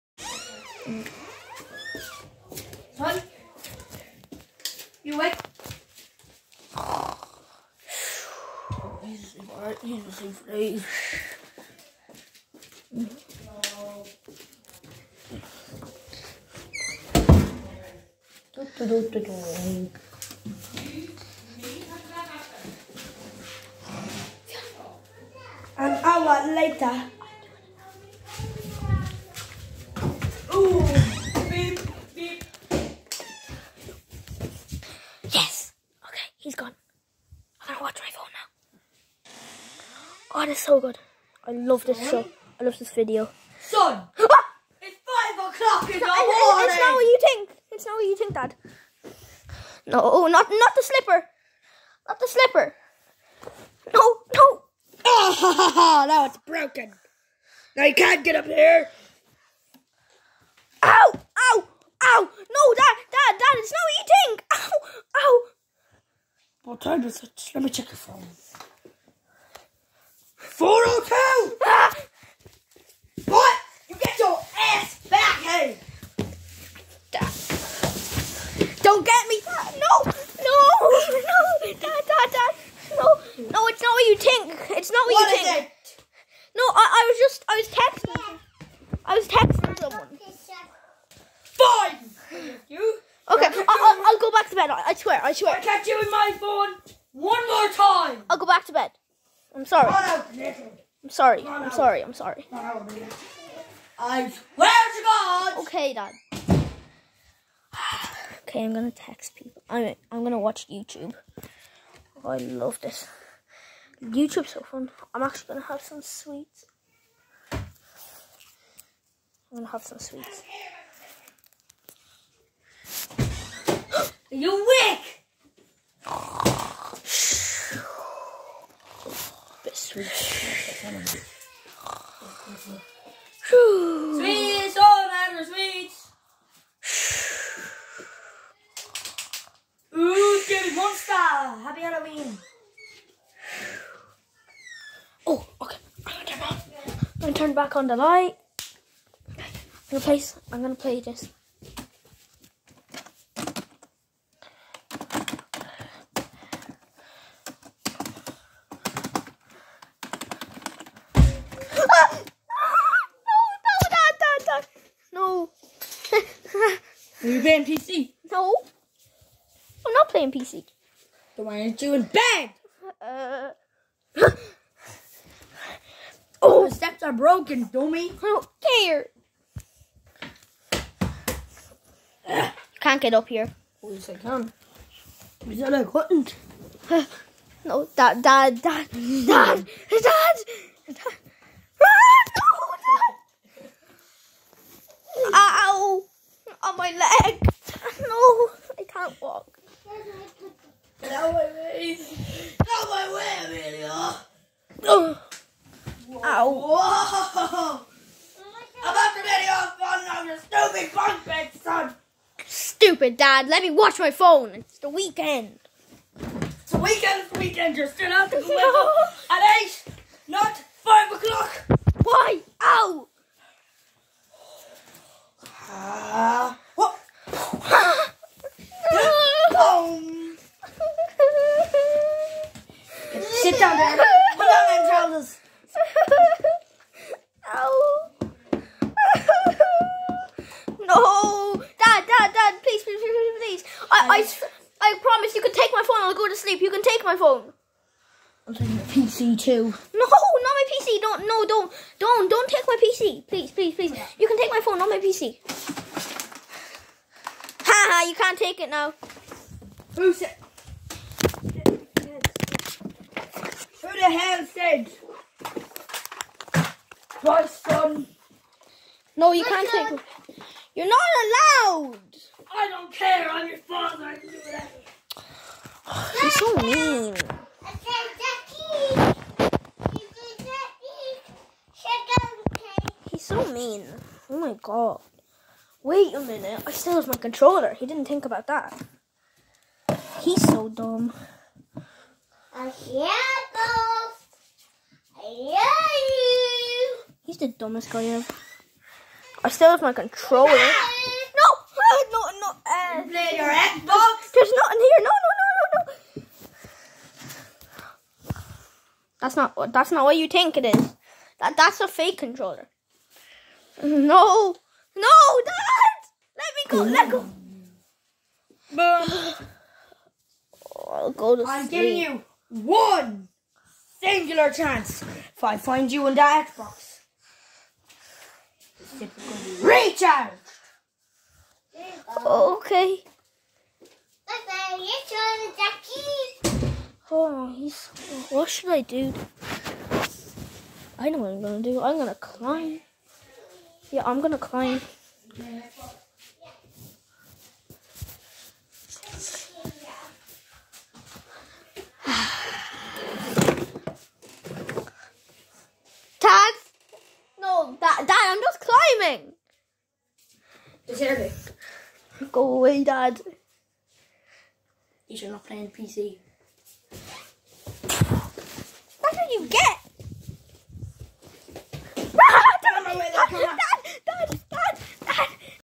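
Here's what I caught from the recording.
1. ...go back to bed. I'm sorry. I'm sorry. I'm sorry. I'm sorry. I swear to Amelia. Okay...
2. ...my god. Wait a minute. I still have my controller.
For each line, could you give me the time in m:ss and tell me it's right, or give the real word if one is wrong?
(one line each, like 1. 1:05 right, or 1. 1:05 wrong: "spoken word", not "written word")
1. 1:38 wrong: "God", not "Amelia"
2. 4:44 right.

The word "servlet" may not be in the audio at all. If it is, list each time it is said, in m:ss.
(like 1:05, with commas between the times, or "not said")
not said.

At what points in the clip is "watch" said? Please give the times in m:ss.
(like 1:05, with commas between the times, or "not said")
0:37, 1:50, 3:33.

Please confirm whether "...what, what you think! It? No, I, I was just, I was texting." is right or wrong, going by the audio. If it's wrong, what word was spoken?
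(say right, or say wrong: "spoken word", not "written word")
right.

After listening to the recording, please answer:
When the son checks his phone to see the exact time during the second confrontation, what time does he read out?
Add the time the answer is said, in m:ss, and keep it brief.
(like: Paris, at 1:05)
4:02, at 1:10.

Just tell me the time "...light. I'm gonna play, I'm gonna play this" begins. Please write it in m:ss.
2:27.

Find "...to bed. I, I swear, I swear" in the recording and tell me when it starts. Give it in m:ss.
1:34.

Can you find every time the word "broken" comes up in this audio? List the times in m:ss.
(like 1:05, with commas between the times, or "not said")
0:56, 2:57.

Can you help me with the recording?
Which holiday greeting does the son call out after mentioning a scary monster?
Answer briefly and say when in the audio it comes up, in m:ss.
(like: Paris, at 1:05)
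Happy Halloween, at 2:21.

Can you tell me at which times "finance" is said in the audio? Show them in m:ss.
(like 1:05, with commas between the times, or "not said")
not said.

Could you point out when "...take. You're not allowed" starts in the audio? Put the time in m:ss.
4:29.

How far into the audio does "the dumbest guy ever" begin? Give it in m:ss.
4:57.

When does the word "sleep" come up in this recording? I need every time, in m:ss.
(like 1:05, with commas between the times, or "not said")
4:06, 5:21.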